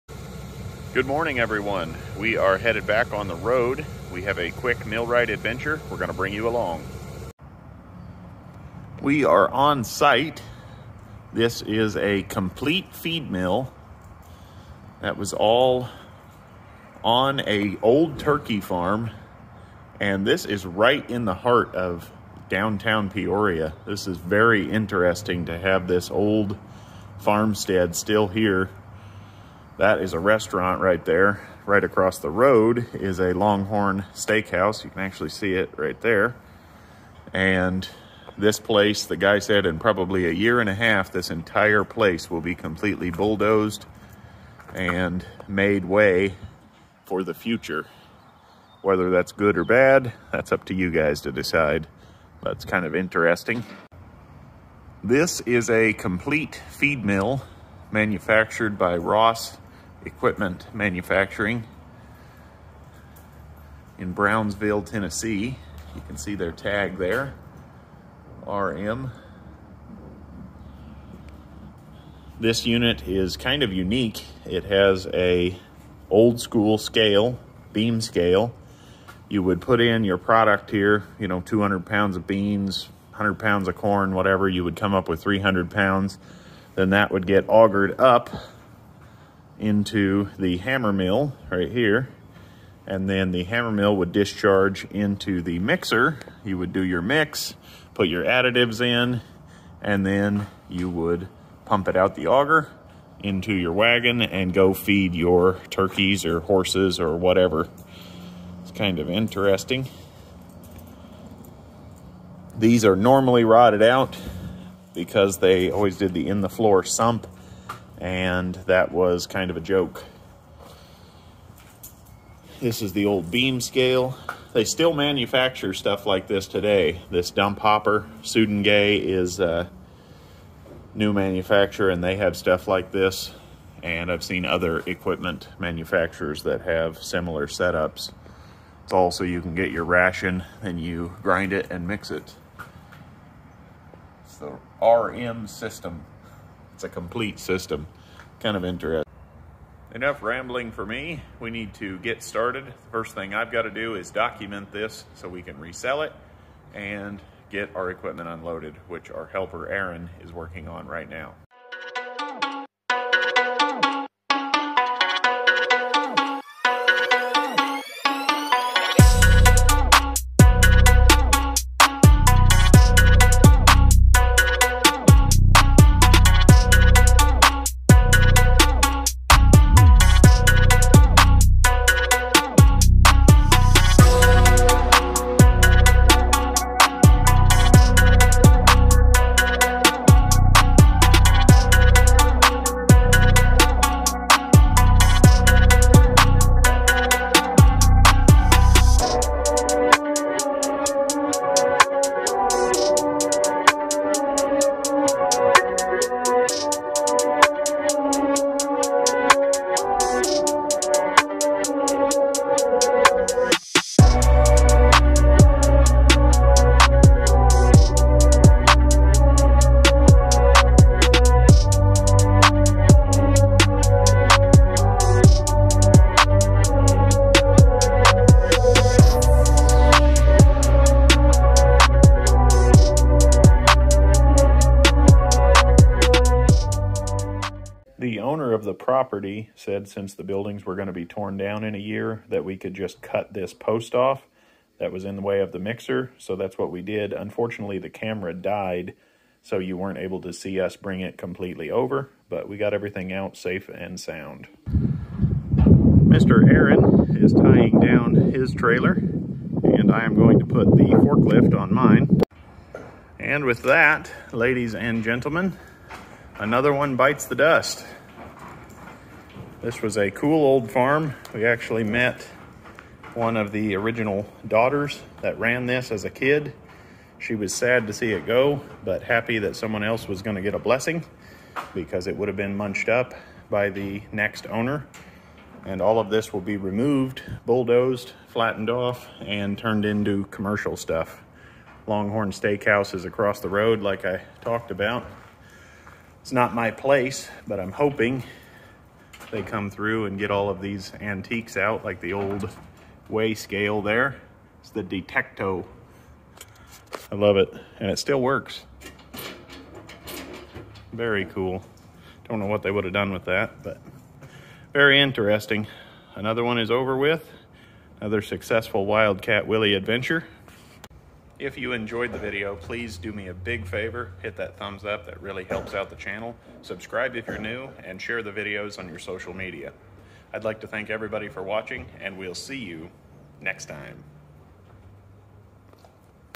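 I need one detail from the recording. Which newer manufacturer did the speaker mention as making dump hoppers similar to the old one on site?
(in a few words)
Sudenga.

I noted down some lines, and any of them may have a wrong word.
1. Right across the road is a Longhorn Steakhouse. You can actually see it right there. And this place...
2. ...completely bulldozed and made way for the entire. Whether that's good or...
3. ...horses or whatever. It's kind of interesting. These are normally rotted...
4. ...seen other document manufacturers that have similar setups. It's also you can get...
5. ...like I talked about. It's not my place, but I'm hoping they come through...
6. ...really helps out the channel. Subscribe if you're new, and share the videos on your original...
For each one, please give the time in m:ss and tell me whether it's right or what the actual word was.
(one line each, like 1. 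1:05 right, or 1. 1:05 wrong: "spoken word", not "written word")
1. 0:31 right
2. 0:42 wrong: "future", not "entire"
3. 1:46 right
4. 2:14 wrong: "equipment", not "document"
5. 4:53 right
6. 5:25 wrong: "social", not "original".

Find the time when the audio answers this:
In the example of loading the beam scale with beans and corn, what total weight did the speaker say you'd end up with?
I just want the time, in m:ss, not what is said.
1:25.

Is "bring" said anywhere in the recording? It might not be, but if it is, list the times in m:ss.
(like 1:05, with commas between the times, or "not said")
0:06, 4:10.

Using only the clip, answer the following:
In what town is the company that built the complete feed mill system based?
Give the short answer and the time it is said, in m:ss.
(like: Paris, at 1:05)
Brownsville, Tennessee, at 1:04.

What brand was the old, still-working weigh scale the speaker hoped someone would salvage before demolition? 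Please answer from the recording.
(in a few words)
Detecto.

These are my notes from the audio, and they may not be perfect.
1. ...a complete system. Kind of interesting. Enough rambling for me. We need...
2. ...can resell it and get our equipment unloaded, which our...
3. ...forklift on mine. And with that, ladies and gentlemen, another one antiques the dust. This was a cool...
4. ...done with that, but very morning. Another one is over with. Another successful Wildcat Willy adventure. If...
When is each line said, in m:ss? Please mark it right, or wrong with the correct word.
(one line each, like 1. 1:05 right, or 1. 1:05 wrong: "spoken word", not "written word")
1. 2:26 right
2. 2:35 right
3. 4:20 wrong: "bites", not "antiques"
4. 5:12 wrong: "interesting", not "morning".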